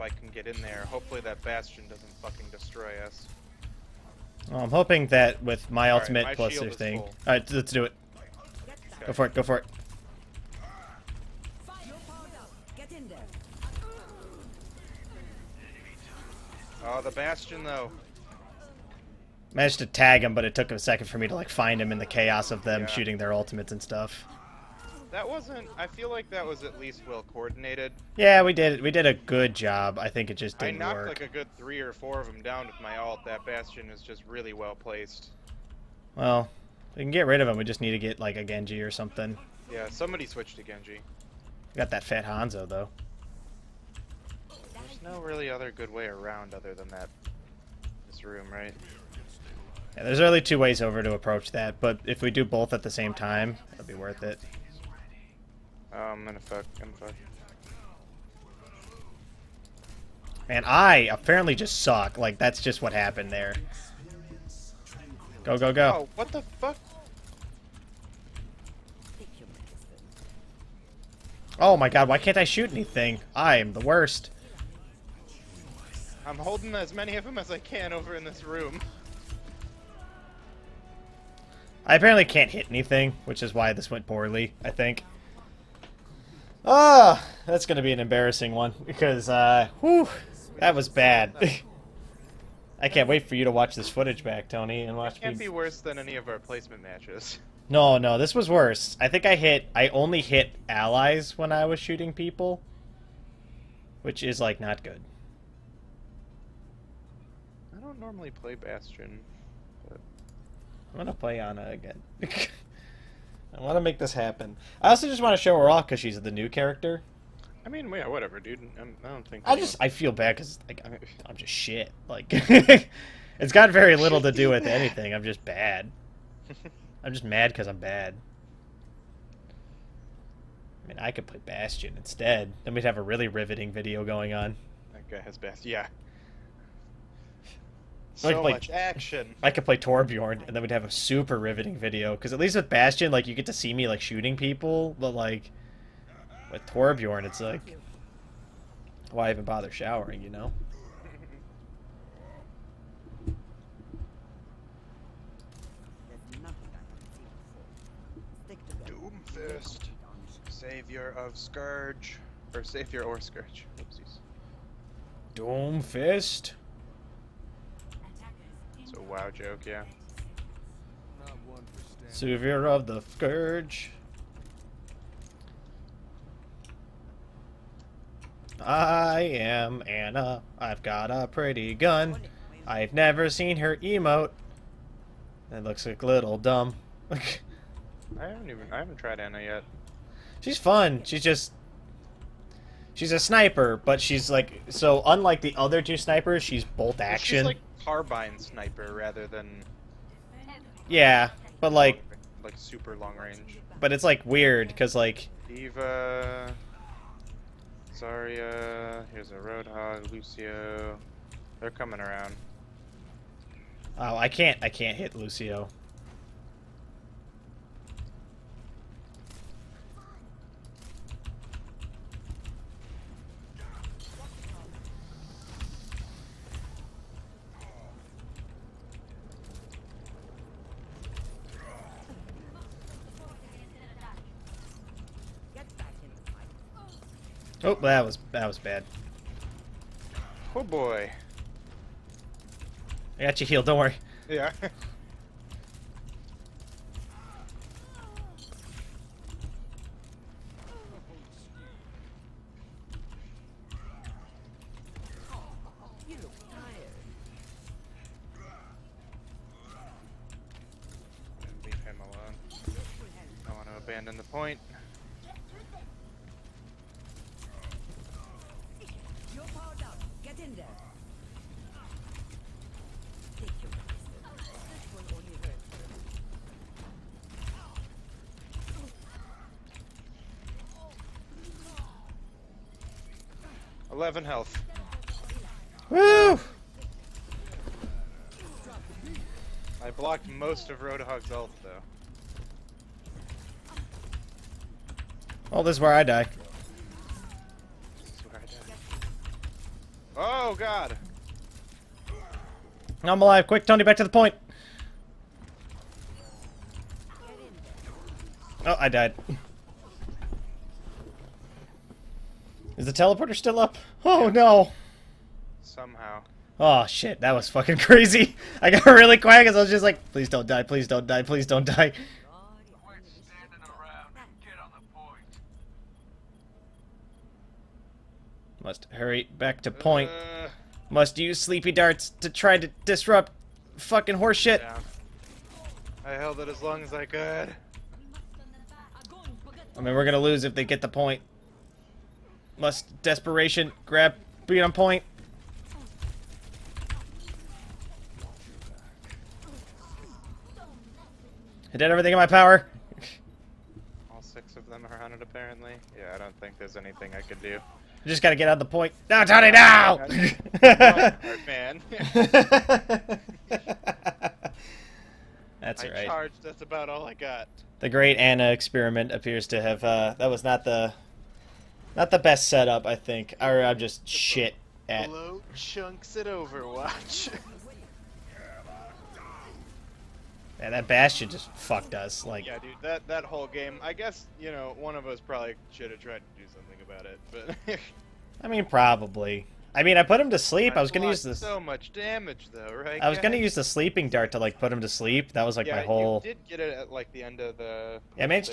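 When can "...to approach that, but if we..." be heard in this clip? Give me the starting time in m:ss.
0:51.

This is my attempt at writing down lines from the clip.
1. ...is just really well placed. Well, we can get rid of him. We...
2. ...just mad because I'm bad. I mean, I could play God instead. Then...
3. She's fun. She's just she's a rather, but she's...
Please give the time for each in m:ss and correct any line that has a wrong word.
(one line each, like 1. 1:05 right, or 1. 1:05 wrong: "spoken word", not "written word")
1. 0:33 right
2. 2:07 wrong: "Bastion", not "God"
3. 3:10 wrong: "sniper", not "rather".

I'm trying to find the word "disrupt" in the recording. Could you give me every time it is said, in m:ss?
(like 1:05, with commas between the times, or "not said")
5:32.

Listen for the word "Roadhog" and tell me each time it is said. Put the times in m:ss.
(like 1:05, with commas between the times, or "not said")
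3:29, 4:50.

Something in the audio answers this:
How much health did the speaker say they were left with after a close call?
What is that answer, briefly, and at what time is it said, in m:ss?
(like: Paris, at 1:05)
11, at 4:43.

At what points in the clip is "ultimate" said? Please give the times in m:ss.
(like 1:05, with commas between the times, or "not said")
0:05, 0:23.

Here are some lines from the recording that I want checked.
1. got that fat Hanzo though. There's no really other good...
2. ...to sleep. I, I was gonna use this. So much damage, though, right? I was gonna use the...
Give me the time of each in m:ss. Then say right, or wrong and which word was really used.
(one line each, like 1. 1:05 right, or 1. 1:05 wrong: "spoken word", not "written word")
1. 0:41 right
2. 6:30 right.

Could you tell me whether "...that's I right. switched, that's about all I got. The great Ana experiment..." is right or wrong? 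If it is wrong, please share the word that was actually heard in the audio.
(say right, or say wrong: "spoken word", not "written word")
wrong: "charged", not "switched".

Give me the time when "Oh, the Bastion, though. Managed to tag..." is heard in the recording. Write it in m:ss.
0:16.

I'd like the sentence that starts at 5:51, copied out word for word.
I did everything in my power.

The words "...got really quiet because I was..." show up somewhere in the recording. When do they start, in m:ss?
5:18.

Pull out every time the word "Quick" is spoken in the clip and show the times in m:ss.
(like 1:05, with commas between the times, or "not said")
5:03.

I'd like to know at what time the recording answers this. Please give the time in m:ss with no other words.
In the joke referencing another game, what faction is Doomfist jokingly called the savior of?
2:52.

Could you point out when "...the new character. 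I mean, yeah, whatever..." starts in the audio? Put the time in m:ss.
1:56.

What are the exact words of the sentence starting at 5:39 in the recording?
I mean, we're gonna lose if they get the point.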